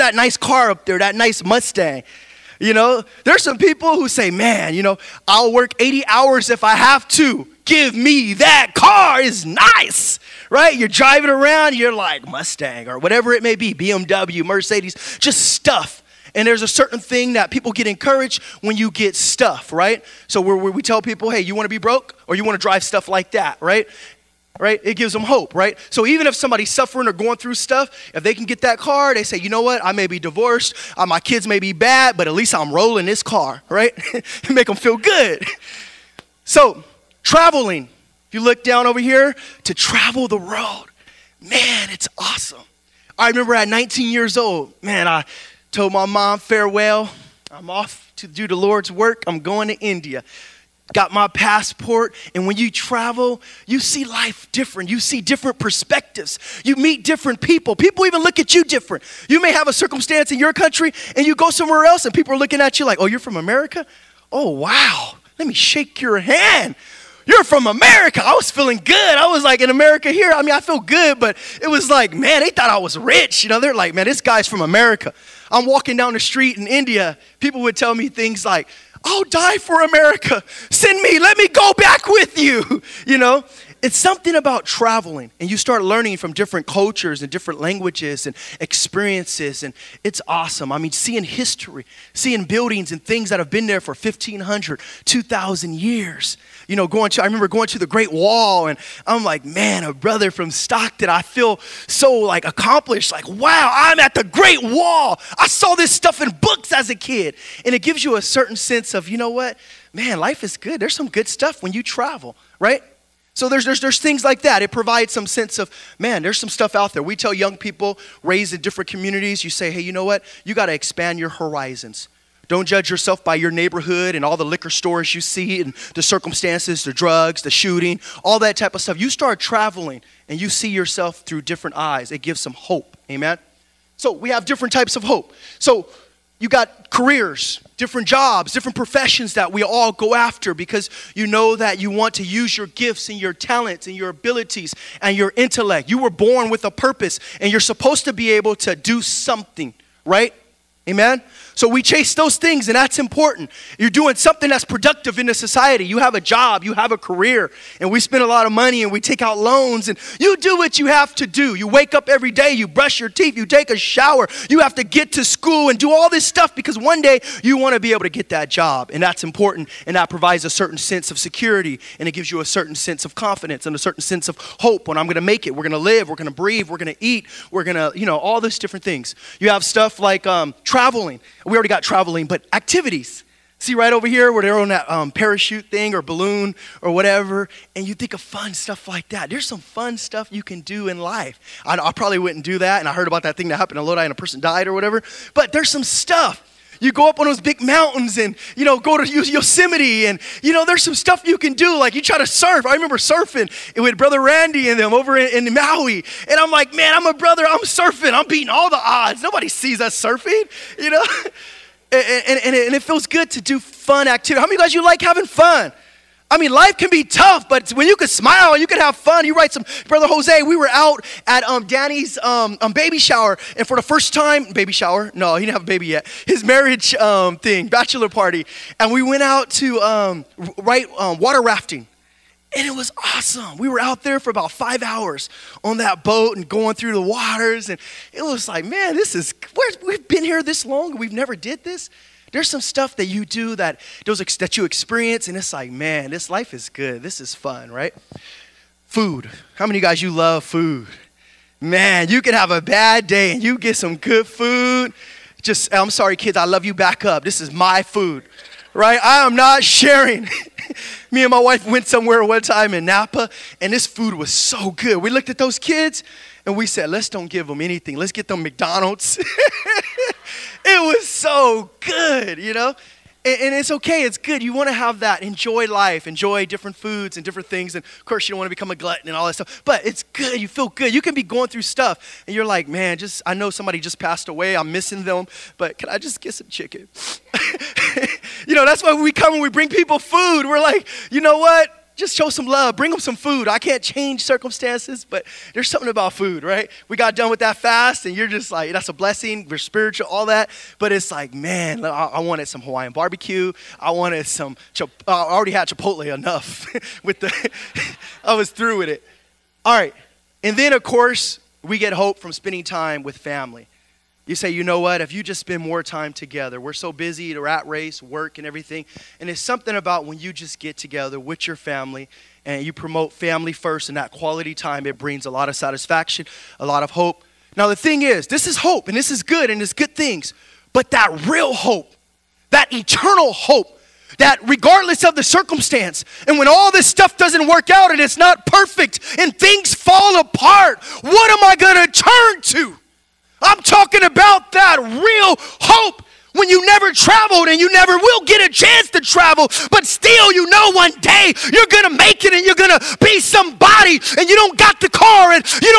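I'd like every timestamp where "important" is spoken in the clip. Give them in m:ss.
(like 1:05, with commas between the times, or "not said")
2:32, 2:49.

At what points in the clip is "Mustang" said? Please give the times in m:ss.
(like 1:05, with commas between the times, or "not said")
0:01, 0:12.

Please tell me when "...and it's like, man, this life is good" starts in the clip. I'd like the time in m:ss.
4:05.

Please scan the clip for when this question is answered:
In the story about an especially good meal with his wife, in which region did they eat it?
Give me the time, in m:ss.
4:22.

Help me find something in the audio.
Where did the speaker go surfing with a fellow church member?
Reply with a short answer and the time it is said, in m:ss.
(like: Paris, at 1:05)
Maui, at 3:25.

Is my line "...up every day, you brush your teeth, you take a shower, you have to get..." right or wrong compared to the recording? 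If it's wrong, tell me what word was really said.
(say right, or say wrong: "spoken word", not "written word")
right.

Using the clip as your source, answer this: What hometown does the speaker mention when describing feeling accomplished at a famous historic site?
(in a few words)
Stockton.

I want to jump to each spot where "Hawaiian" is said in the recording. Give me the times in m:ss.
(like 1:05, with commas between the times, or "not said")
5:02.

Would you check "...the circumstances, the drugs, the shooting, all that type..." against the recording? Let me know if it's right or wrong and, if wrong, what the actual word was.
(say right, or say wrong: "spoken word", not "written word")
right.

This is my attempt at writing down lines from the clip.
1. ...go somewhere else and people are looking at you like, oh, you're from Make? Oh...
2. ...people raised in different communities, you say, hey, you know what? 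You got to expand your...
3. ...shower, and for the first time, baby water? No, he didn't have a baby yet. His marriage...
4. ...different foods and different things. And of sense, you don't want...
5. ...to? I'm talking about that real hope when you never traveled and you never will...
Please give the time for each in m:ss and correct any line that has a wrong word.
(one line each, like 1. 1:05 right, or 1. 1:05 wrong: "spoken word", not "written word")
1. 1:01 wrong: "America", not "Make"
2. 1:57 right
3. 3:42 wrong: "shower", not "water"
4. 4:36 wrong: "course", not "sense"
5. 5:42 right.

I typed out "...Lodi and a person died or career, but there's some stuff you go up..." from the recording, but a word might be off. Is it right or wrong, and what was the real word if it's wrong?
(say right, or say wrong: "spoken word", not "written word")
wrong: "whatever", not "career".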